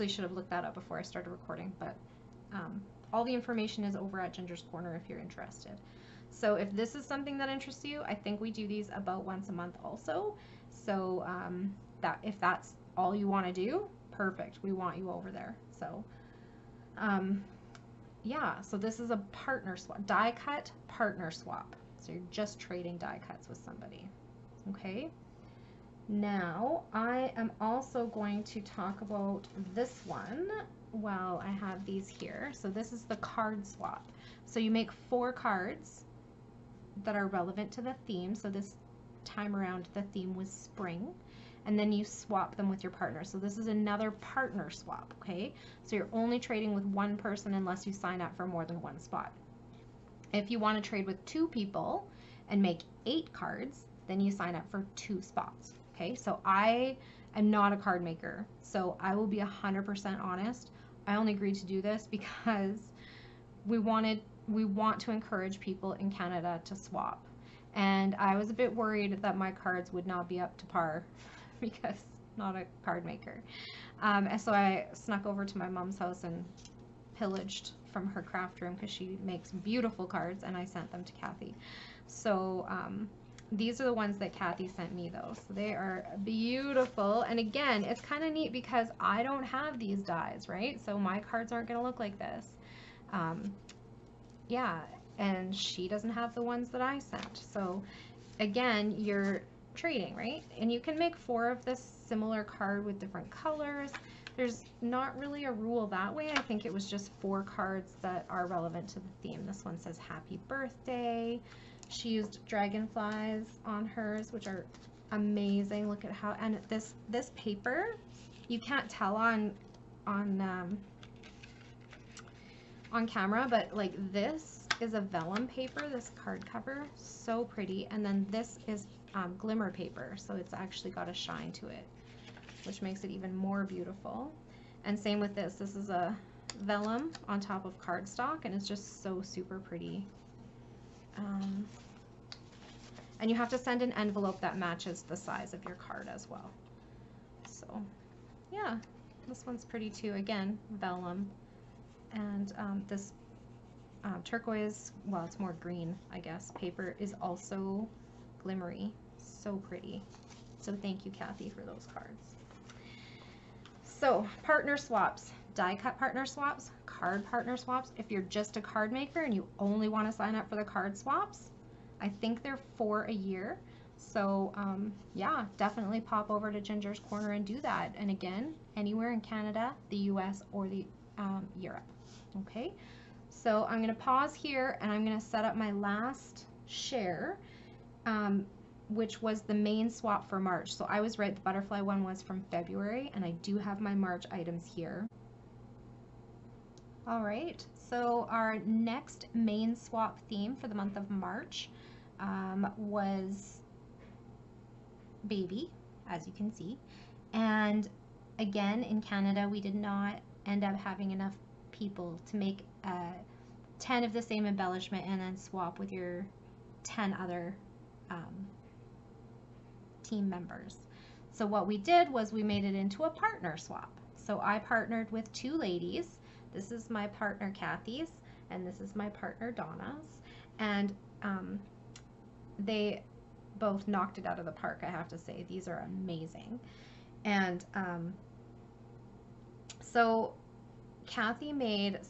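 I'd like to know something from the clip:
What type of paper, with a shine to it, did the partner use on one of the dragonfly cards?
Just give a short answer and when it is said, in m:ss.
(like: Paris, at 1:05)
Glimmer paper, at 2:09.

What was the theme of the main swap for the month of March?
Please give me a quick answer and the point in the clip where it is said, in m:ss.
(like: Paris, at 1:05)
Baby, at 3:25.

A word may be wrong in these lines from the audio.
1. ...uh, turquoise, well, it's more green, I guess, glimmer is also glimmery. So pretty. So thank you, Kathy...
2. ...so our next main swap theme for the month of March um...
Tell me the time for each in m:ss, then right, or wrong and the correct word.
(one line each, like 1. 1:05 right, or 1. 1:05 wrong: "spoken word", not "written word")
1. 2:34 wrong: "paper", not "glimmer"
2. 3:17 right.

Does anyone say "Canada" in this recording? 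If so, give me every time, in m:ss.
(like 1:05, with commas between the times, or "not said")
1:06, 2:59, 3:29.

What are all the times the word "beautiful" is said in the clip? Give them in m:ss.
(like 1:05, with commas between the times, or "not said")
1:19, 1:26, 2:13.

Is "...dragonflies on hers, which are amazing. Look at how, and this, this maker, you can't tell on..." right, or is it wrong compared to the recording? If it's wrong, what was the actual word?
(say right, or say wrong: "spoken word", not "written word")
wrong: "paper", not "maker".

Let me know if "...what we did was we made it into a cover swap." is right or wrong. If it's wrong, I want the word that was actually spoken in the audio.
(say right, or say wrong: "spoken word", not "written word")
wrong: "partner", not "cover".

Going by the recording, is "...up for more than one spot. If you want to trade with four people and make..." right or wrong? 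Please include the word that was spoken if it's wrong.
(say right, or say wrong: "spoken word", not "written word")
wrong: "two", not "four".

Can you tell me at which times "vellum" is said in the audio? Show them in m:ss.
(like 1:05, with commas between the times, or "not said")
2:05, 2:16, 2:30.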